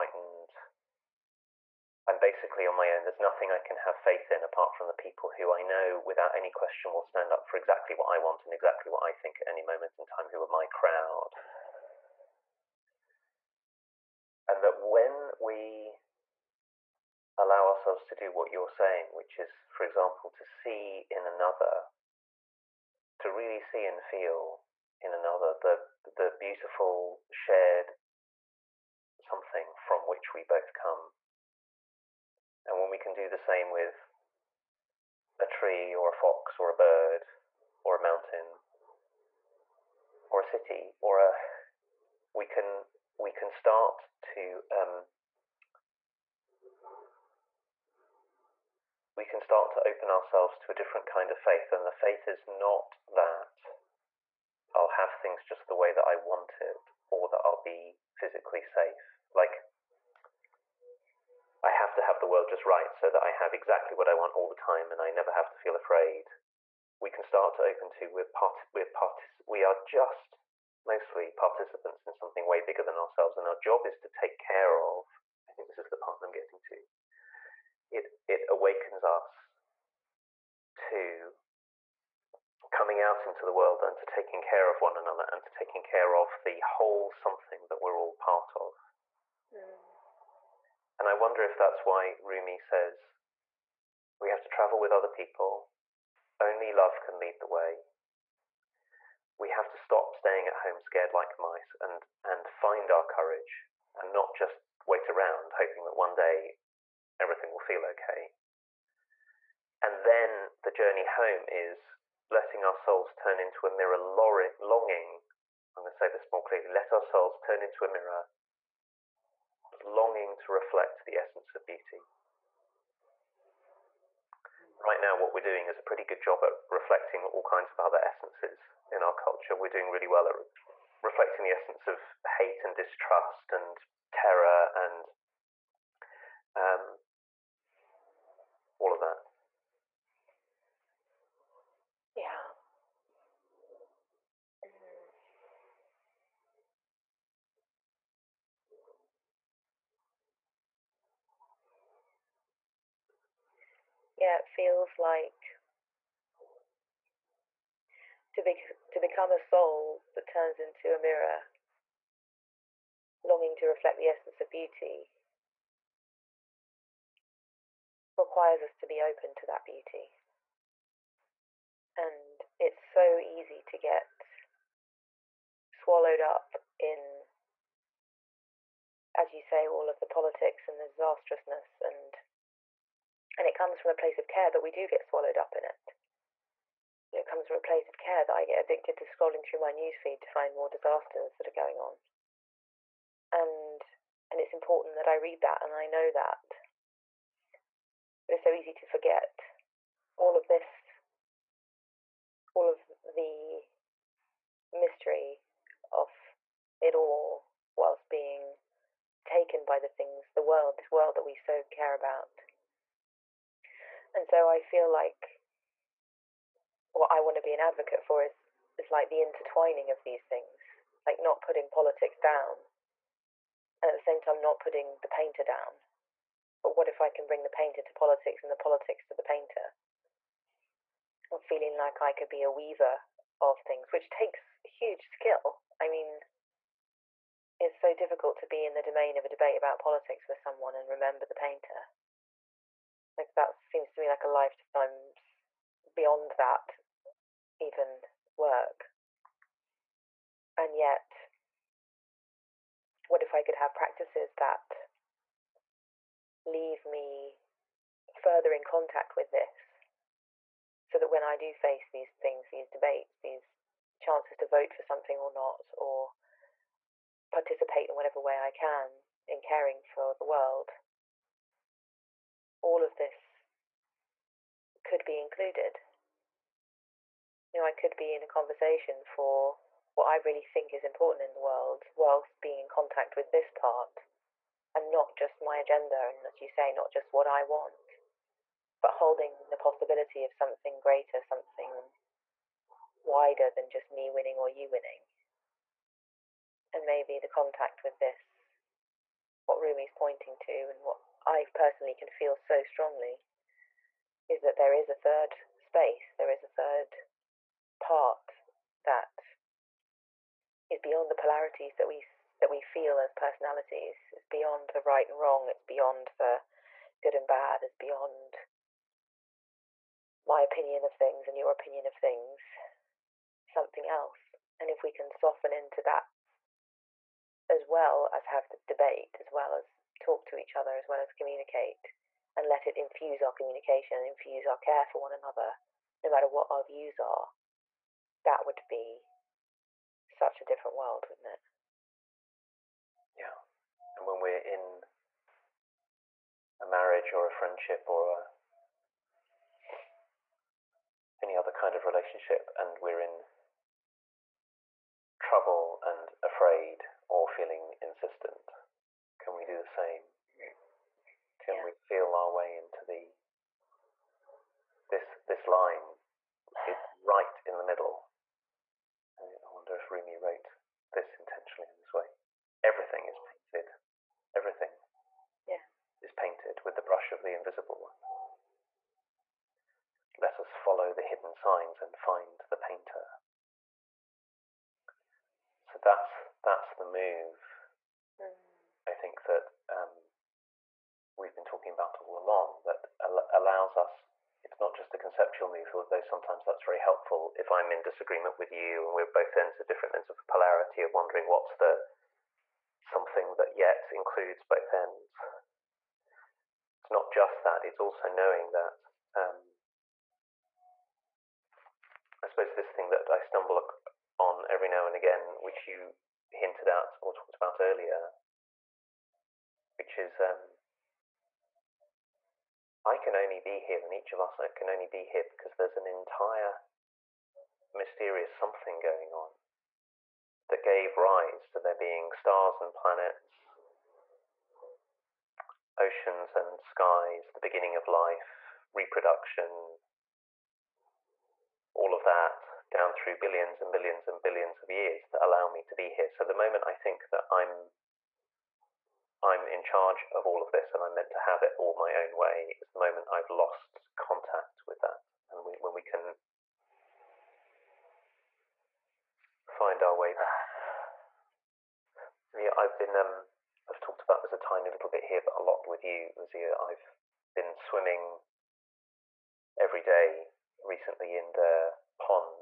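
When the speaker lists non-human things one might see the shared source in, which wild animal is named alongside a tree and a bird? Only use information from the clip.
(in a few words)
fox.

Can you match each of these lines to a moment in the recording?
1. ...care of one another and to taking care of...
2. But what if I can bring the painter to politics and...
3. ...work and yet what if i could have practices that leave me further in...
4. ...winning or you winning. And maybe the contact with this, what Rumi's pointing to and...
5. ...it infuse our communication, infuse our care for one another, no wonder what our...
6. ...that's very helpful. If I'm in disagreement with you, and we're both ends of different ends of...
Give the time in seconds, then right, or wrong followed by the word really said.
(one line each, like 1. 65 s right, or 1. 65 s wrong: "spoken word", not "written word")
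1. 84 s right
2. 226 s right
3. 248 s right
4. 294 s right
5. 332 s wrong: "matter", not "wonder"
6. 396 s right.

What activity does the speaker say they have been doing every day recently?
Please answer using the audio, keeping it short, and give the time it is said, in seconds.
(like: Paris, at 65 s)
swimming, at 467 s.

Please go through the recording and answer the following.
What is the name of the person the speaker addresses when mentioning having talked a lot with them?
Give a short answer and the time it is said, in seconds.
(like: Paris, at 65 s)
Lucia, at 466 s.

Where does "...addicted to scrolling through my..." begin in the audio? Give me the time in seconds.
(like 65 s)
188 s.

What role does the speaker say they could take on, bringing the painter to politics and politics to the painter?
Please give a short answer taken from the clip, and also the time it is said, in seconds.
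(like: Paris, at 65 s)
weaver, at 232 s.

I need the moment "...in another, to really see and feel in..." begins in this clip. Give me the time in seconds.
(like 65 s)
21 s.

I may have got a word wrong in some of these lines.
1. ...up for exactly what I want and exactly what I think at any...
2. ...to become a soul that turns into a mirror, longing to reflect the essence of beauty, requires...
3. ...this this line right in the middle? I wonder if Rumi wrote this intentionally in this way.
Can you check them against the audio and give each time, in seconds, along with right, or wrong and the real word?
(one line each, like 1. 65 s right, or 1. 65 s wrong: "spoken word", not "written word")
1. 7 s right
2. 158 s right
3. 364 s right.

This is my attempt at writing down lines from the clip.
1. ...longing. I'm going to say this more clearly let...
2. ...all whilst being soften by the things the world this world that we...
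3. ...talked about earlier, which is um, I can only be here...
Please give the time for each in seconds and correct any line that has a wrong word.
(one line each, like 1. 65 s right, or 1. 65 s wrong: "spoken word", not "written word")
1. 113 s right
2. 206 s wrong: "taken", not "soften"
3. 417 s right.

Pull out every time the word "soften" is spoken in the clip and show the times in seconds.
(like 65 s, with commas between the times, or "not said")
325 s.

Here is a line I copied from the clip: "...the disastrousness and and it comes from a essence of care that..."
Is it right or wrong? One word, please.
wrong.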